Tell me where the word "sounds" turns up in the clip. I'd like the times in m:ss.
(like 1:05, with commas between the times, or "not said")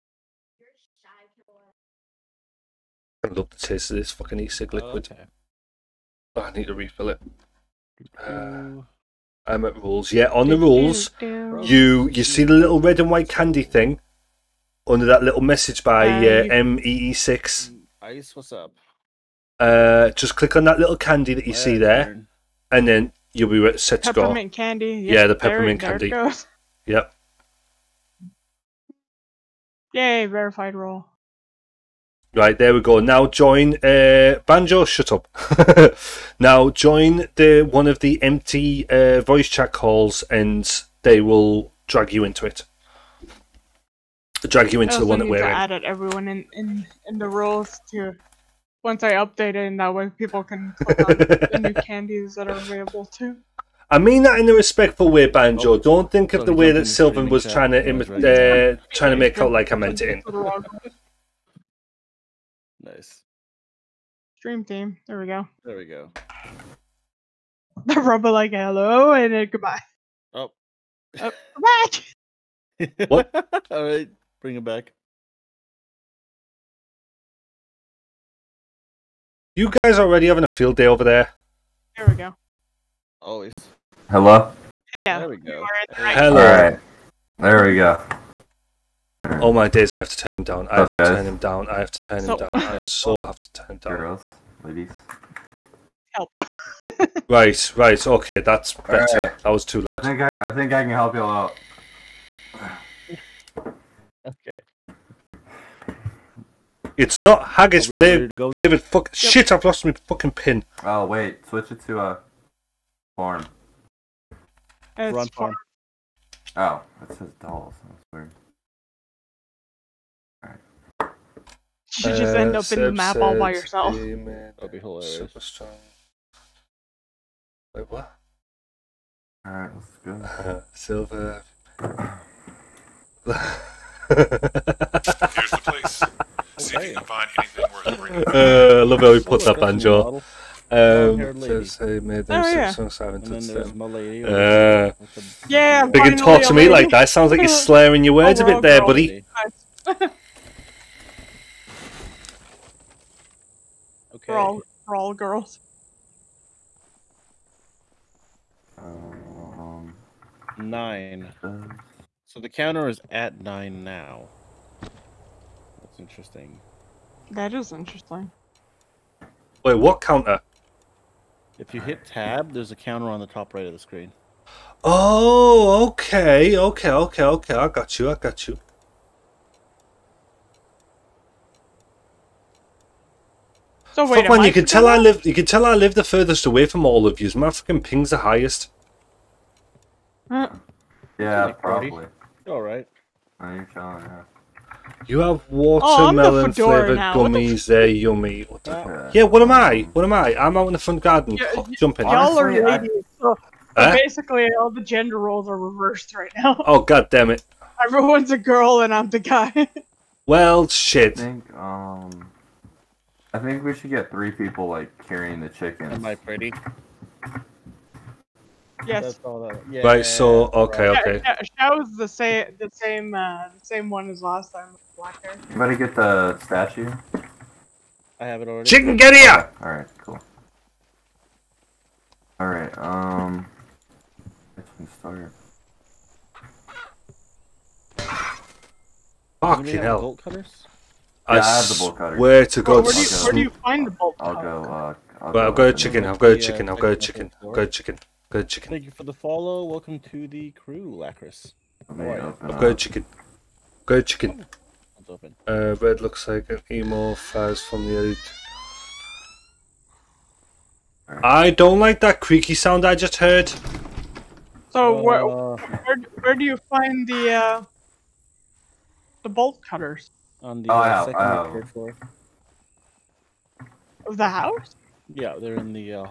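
2:27, 4:22.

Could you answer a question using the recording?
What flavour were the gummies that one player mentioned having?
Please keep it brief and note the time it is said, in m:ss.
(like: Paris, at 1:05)
Watermelon, at 3:15.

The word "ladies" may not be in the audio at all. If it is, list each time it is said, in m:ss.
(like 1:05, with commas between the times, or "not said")
1:34, 3:22.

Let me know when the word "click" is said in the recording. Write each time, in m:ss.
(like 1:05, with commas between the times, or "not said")
0:20, 0:50.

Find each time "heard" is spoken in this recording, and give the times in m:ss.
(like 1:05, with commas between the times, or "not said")
4:23.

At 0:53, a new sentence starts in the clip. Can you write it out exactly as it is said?
I mean that in a respectful way, Banjo.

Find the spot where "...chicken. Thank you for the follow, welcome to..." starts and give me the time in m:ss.
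4:08.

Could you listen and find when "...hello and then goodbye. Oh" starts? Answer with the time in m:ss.
1:08.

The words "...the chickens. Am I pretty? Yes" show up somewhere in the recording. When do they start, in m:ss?
3:35.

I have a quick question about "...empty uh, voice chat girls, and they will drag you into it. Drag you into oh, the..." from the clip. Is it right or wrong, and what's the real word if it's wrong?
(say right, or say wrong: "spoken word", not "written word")
wrong: "calls", not "girls".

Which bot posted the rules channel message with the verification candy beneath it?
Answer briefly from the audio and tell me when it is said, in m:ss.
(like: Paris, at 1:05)
MEE6, at 0:16.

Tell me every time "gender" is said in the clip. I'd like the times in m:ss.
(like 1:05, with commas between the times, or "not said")
3:24.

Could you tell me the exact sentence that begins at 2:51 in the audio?
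If you hit tab, there's a counter on the top right of the screen.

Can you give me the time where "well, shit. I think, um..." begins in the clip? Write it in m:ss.
3:30.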